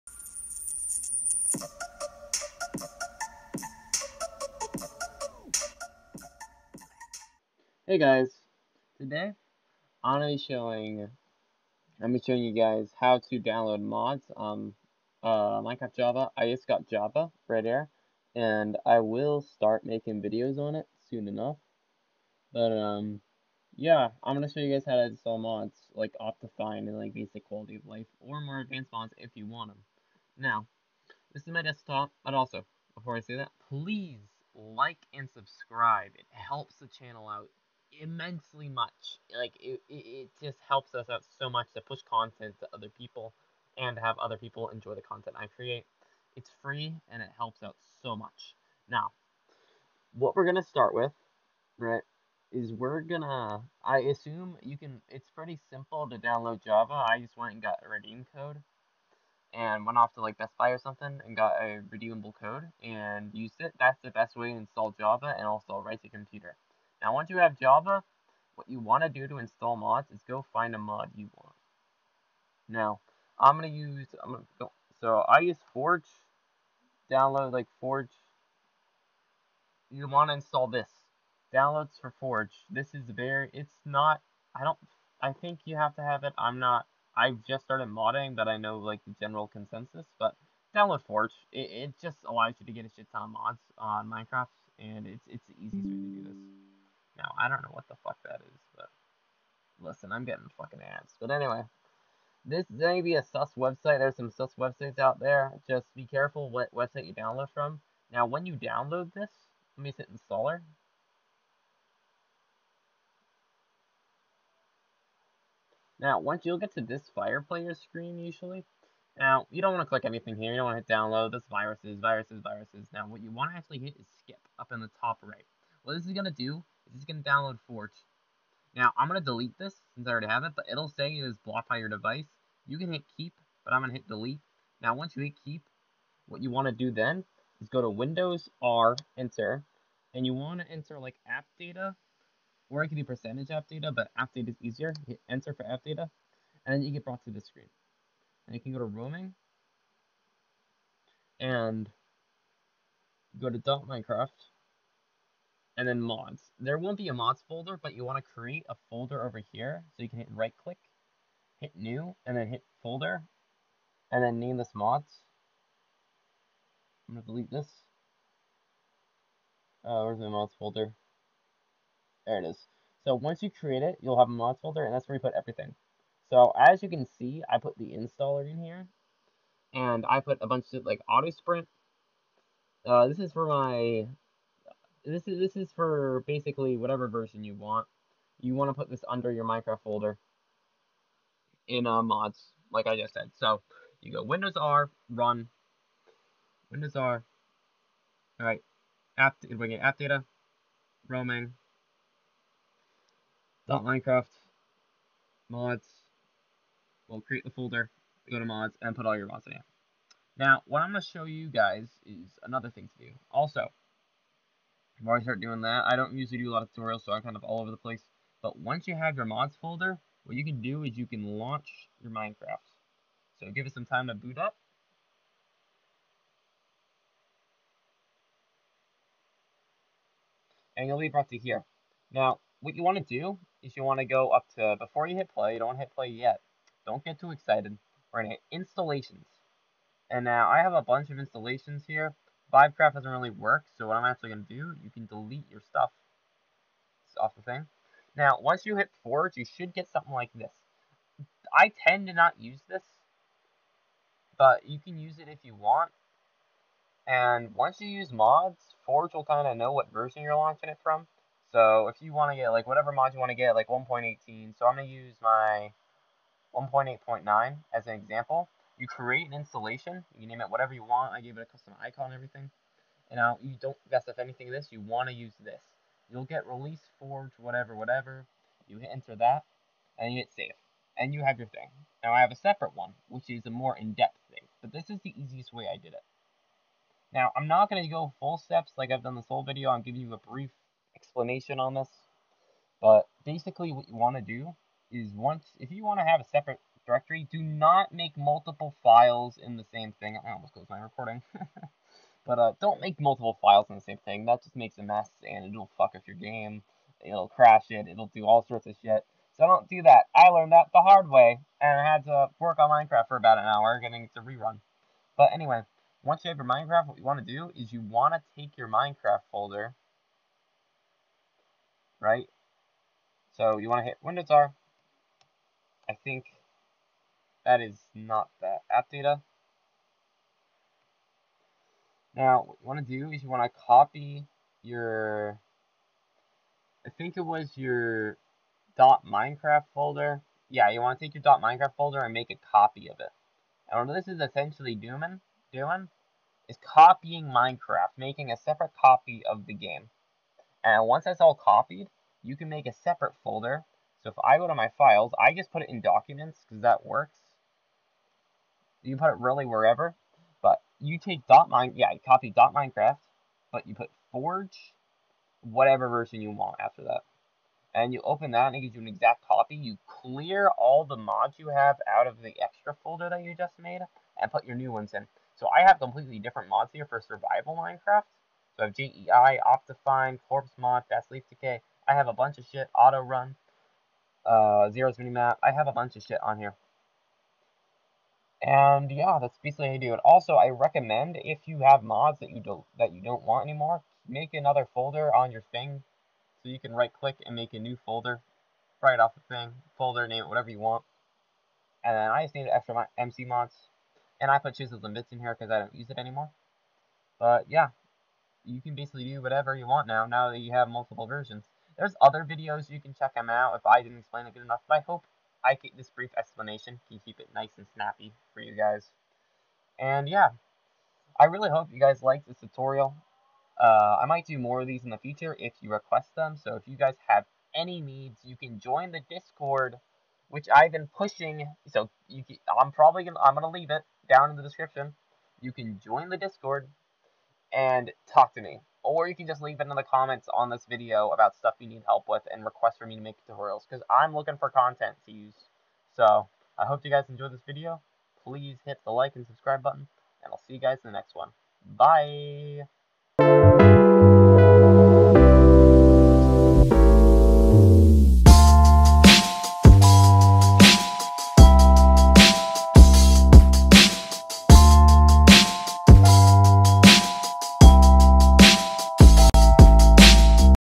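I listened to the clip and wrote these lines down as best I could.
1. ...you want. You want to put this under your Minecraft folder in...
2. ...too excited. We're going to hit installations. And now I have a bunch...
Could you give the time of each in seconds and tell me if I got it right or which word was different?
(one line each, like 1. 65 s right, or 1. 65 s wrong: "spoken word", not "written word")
1. 187 s right
2. 237 s right.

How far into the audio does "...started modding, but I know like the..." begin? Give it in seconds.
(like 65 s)
87 s.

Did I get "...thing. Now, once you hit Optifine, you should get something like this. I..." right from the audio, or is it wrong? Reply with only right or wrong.
wrong.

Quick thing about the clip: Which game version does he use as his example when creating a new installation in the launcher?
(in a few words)
1.8.9.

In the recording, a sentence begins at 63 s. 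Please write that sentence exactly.
That's the best way to install Java and also write to computer.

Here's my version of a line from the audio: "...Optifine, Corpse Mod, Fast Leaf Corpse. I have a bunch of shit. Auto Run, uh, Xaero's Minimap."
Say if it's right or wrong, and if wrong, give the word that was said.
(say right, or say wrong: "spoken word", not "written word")
wrong: "Decay", not "Corpse".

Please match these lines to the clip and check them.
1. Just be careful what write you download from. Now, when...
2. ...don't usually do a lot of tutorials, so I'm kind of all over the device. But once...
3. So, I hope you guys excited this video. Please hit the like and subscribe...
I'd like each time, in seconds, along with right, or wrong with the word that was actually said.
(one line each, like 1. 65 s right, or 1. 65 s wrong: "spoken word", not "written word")
1. 105 s wrong: "website", not "write"
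2. 215 s wrong: "place", not "device"
3. 445 s wrong: "enjoyed", not "excited".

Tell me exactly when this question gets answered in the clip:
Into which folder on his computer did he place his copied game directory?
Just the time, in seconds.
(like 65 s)
355 s.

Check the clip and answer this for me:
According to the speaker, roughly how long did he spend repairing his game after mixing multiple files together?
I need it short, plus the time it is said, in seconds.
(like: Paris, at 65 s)
about an hour, at 313 s.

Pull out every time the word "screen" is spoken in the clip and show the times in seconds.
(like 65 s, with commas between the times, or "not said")
117 s, 147 s.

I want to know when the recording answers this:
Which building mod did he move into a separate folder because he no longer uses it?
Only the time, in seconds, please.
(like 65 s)
404 s.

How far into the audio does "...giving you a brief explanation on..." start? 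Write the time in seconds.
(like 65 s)
289 s.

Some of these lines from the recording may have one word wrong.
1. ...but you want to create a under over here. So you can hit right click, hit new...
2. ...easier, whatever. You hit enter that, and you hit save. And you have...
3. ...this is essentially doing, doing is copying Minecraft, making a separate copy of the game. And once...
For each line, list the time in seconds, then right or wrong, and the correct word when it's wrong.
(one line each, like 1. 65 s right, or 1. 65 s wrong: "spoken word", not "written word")
1. 157 s wrong: "folder", not "under"
2. 277 s wrong: "whatever", not "easier"
3. 343 s right.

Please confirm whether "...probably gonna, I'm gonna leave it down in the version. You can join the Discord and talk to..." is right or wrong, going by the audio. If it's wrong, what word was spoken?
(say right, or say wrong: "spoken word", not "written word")
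wrong: "description", not "version".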